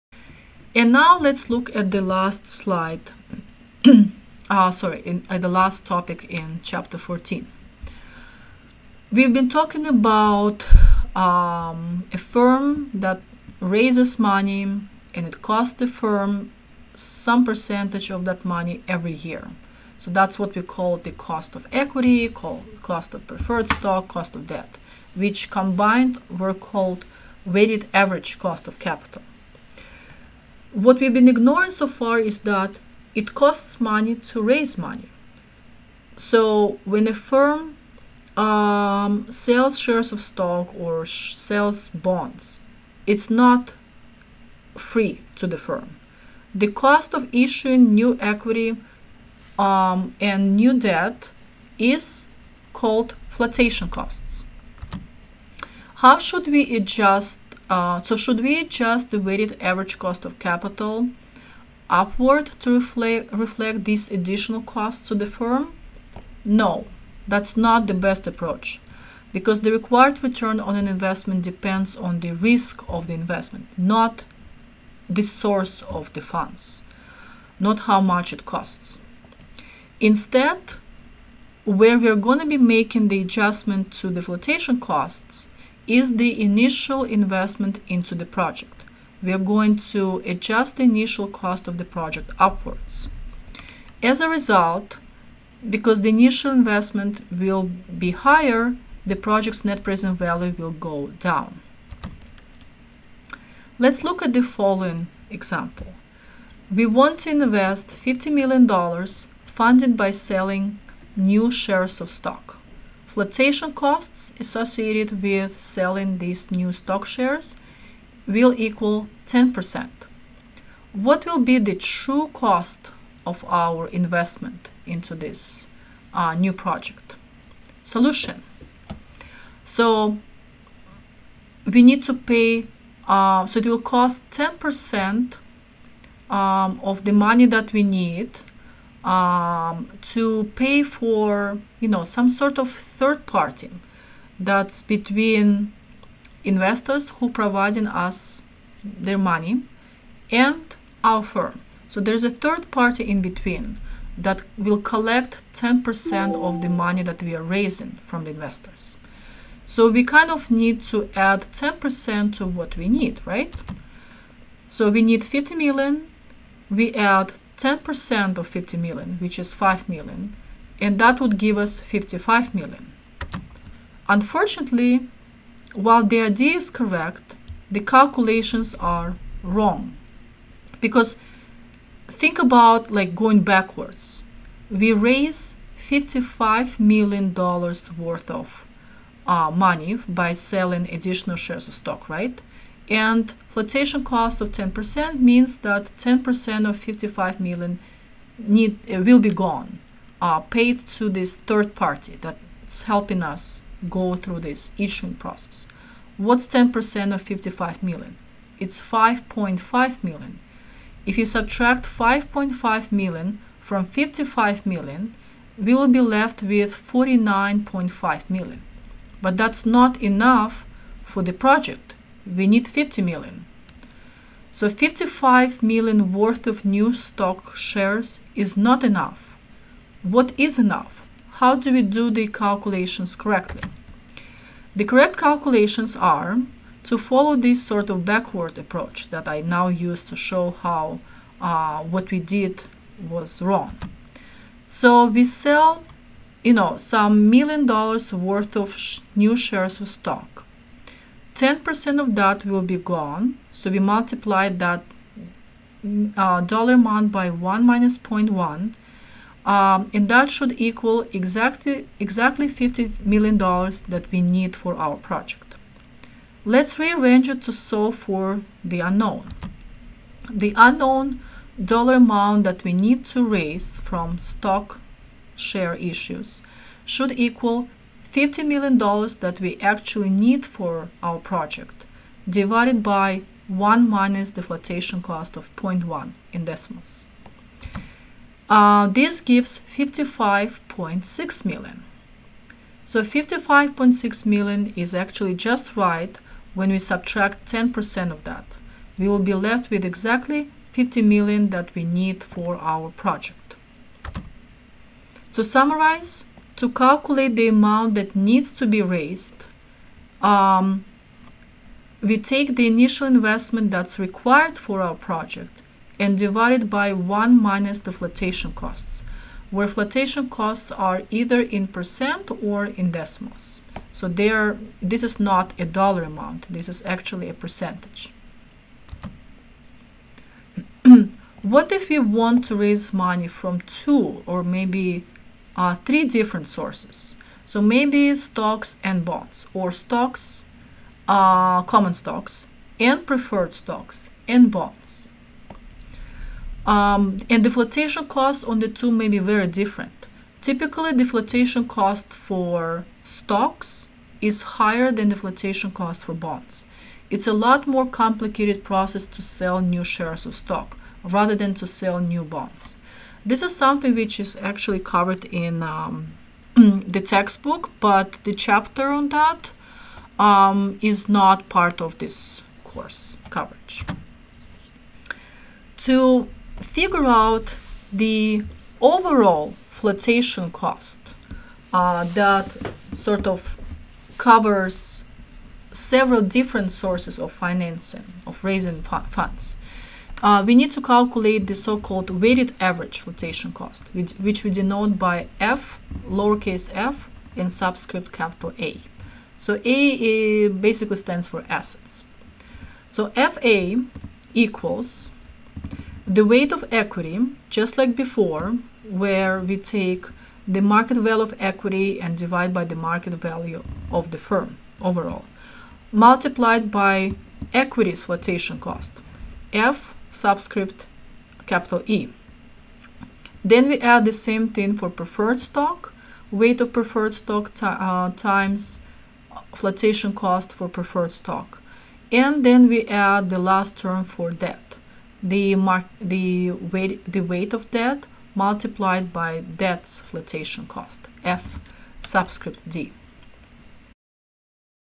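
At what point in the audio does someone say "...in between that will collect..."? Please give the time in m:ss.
2:33.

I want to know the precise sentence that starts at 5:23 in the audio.
So they are, this is not a dollar amount, this is actually a percentage.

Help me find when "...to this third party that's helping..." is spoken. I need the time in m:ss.
3:20.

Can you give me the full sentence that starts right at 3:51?
How do we do the calculations correctly?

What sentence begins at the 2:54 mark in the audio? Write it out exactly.
Unfortunately, while the idea is correct, the calculations are wrong.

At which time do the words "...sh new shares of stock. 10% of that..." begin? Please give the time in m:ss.
4:08.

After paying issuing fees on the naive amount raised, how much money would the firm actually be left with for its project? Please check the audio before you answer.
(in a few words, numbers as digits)
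49.5 million.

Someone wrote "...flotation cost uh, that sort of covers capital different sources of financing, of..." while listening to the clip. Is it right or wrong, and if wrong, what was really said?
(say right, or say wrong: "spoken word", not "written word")
wrong: "several", not "capital".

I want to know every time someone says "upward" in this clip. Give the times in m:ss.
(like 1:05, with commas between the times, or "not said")
1:01, 1:32.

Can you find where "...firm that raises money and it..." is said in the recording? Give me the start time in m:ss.
0:12.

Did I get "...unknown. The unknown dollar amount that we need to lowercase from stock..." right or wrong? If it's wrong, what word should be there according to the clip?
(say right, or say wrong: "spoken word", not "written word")
wrong: "raise", not "lowercase".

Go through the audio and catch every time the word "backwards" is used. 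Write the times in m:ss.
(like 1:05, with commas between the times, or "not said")
3:03, 3:58.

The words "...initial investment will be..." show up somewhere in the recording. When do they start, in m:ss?
1:36.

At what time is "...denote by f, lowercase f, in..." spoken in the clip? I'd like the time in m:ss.
6:34.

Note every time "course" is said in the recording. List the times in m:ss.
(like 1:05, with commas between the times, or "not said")
6:12.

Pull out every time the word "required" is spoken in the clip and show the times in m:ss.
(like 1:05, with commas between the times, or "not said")
1:09, 5:13.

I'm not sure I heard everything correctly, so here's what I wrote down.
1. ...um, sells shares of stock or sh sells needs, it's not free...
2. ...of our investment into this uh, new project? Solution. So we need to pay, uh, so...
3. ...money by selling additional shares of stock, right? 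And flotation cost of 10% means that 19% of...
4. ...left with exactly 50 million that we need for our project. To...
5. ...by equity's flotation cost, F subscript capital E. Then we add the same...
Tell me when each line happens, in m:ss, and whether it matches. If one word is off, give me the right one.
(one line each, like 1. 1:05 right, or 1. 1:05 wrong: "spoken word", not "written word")
1. 0:38 wrong: "bonds", not "needs"
2. 2:03 right
3. 3:09 wrong: "10", not "19"
4. 4:59 right
5. 6:56 right.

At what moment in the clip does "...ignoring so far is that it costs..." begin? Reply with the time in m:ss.
0:31.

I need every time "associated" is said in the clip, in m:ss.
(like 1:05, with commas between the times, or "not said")
1:54.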